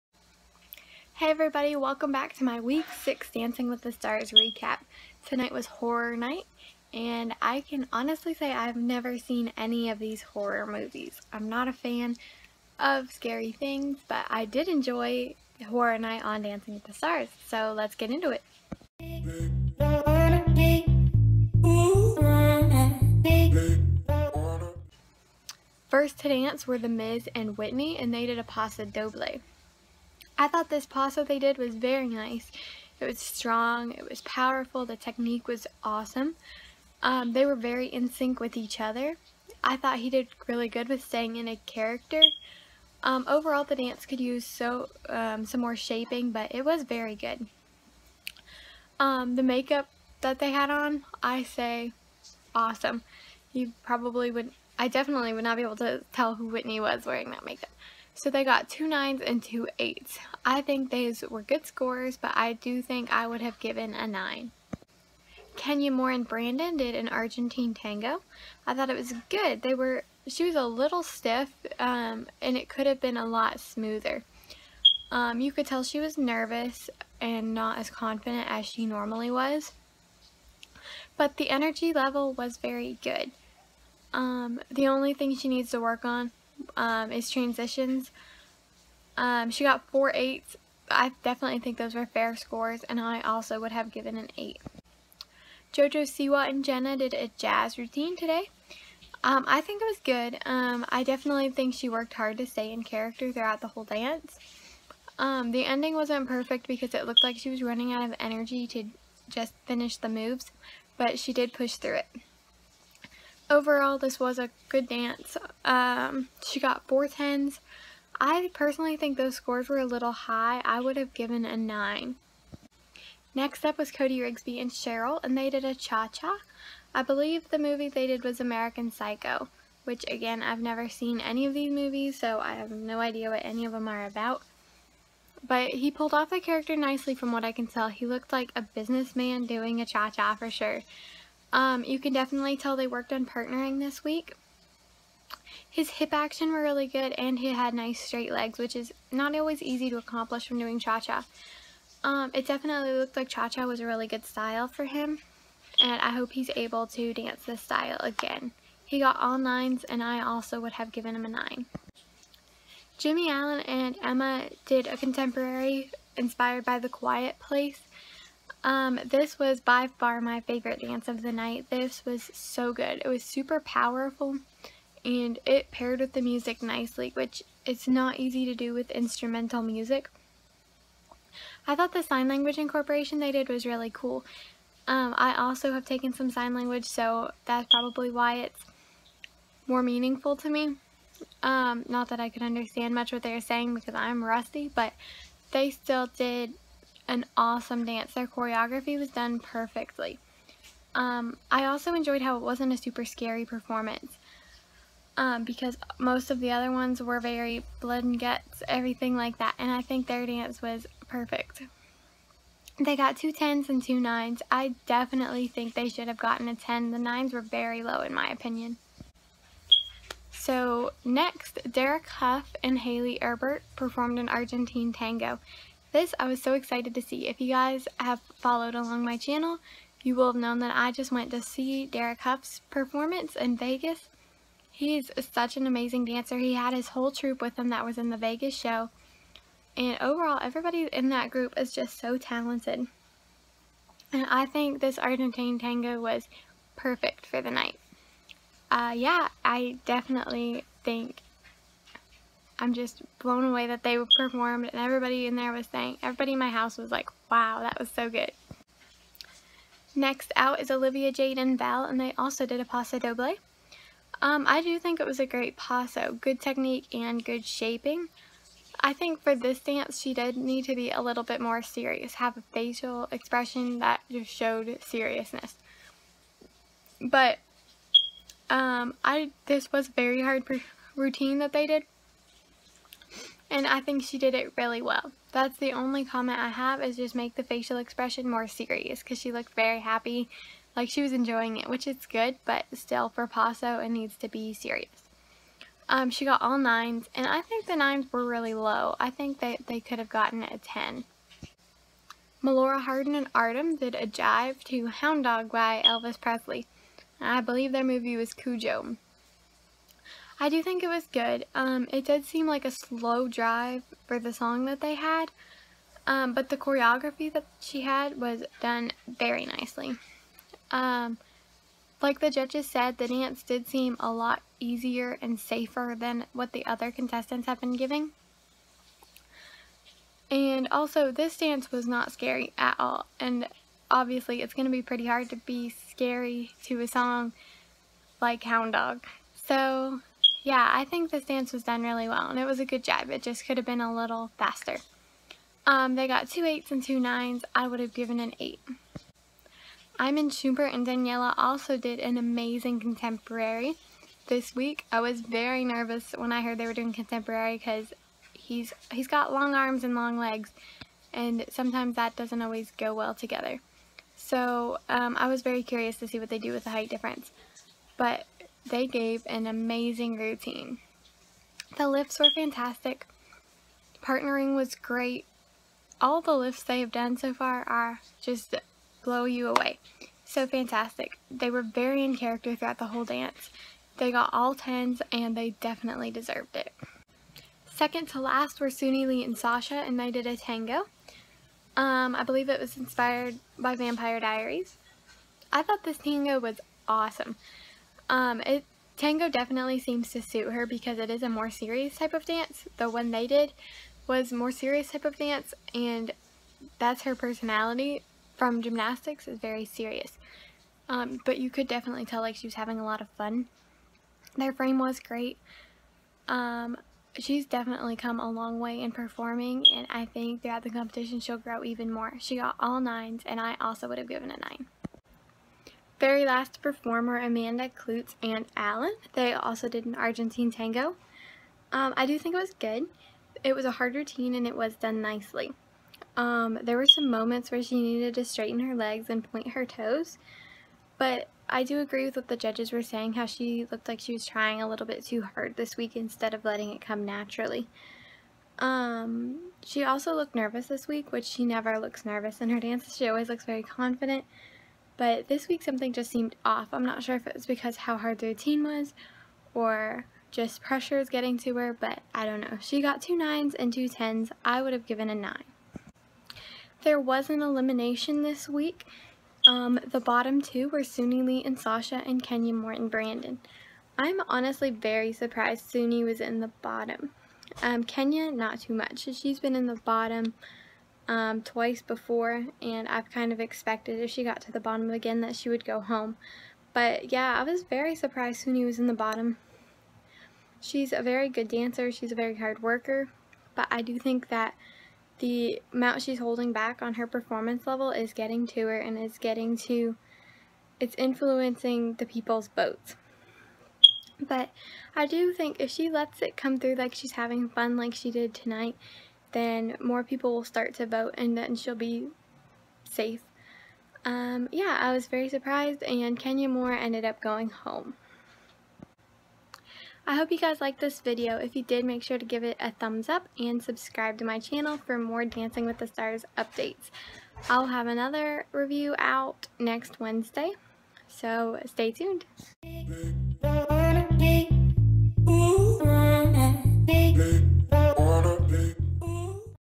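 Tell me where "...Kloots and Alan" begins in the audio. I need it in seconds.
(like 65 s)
427 s.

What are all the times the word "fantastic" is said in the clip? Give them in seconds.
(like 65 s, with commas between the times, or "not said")
372 s, 380 s.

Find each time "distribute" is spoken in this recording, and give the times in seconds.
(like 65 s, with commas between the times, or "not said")
not said.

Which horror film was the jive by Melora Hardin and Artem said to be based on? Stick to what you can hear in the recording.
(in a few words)
Cujo.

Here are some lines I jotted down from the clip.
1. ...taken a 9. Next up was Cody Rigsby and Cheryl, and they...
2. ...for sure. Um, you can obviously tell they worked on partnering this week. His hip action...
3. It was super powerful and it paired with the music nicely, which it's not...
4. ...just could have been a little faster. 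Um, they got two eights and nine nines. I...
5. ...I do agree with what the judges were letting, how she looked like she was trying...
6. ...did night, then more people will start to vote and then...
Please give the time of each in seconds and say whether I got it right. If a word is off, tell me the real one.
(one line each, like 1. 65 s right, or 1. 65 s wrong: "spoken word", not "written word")
1. 121 s wrong: "given", not "taken"
2. 140 s wrong: "definitely", not "obviously"
3. 173 s right
4. 343 s wrong: "two", not "nine"
5. 441 s wrong: "saying", not "letting"
6. 508 s wrong: "tonight", not "night".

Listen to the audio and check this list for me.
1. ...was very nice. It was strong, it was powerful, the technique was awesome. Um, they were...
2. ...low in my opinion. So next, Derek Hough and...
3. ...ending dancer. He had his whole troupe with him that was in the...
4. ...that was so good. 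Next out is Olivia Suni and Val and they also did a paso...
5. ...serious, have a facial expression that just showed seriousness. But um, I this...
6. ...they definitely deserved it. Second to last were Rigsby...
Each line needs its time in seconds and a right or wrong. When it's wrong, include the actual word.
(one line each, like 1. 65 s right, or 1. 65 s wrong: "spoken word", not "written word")
1. 31 s right
2. 217 s right
3. 235 s wrong: "amazing", not "ending"
4. 257 s wrong: "Jade", not "Suni"
5. 271 s right
6. 385 s wrong: "Suni", not "Rigsby".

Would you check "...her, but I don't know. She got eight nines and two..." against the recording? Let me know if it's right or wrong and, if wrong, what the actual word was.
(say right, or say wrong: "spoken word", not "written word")
wrong: "two", not "eight".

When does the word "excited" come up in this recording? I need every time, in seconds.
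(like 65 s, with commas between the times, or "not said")
226 s.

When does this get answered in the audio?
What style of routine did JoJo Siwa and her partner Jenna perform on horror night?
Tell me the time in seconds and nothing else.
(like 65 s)
97 s.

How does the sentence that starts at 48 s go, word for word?
Um, the makeup that they had on, I say awesome.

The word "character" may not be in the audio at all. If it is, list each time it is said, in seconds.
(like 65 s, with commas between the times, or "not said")
41 s, 102 s, 136 s, 382 s.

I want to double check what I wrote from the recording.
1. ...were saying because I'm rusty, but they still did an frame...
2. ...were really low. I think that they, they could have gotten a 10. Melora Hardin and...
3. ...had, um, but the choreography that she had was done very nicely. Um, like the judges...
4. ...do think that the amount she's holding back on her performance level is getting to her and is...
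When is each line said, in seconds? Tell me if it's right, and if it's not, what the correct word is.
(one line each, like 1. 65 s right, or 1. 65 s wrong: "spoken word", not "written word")
1. 193 s wrong: "awesome", not "frame"
2. 298 s right
3. 314 s right
4. 493 s right.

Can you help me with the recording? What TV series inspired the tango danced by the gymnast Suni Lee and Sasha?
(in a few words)
Vampire Diaries.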